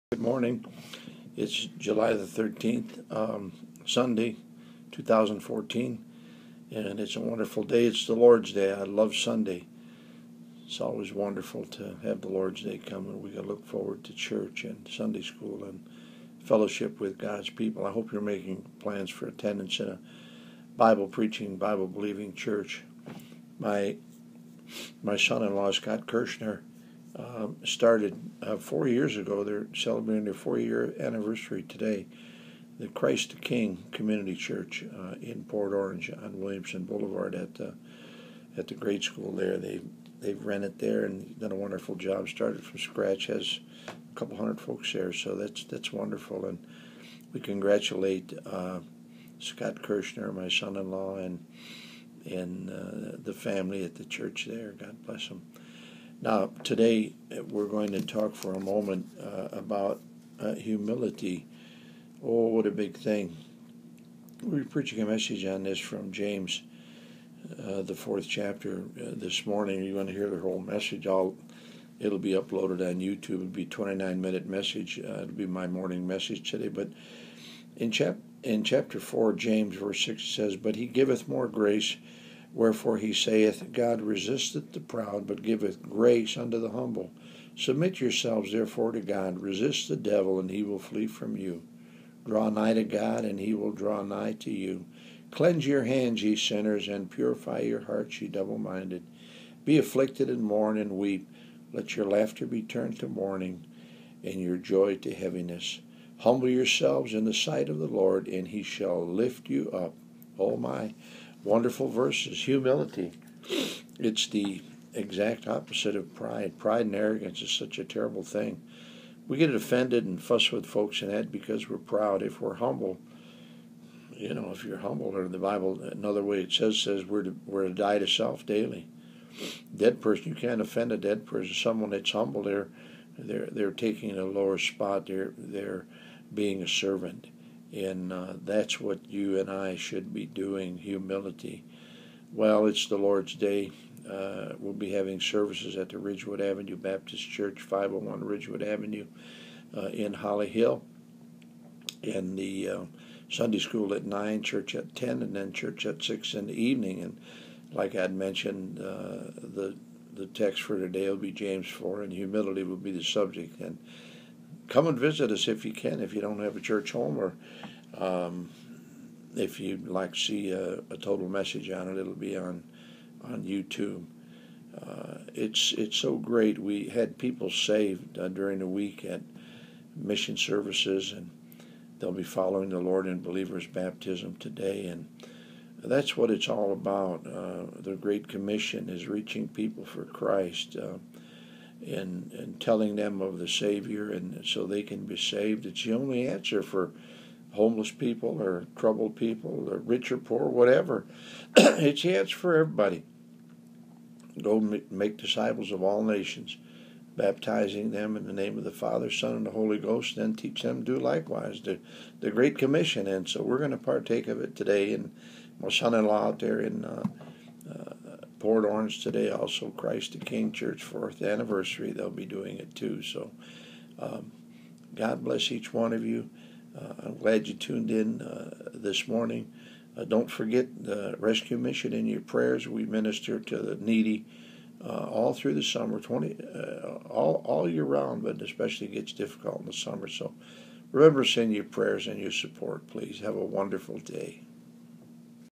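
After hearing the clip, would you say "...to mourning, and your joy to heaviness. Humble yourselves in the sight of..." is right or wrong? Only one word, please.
right.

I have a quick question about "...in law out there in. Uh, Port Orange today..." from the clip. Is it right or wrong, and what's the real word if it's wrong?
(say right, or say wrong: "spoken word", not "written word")
right.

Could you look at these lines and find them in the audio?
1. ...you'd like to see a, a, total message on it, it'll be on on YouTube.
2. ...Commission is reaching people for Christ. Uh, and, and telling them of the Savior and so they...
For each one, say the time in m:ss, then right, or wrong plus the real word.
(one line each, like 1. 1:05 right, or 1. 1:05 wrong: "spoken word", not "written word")
1. 2:49 right
2. 3:08 right.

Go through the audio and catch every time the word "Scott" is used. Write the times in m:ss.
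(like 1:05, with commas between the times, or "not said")
0:25, 0:49.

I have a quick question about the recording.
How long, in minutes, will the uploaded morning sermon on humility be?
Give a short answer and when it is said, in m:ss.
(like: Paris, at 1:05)
29, at 1:13.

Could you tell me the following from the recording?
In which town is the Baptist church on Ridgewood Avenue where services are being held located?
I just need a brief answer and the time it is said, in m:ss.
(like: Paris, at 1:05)
Holly Hill, at 2:30.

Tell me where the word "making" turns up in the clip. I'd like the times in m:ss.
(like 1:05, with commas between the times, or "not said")
0:18.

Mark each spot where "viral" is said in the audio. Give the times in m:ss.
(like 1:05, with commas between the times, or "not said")
not said.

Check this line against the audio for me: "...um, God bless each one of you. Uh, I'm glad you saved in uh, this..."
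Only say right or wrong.
wrong.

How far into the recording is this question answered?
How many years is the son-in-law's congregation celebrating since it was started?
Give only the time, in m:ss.
0:30.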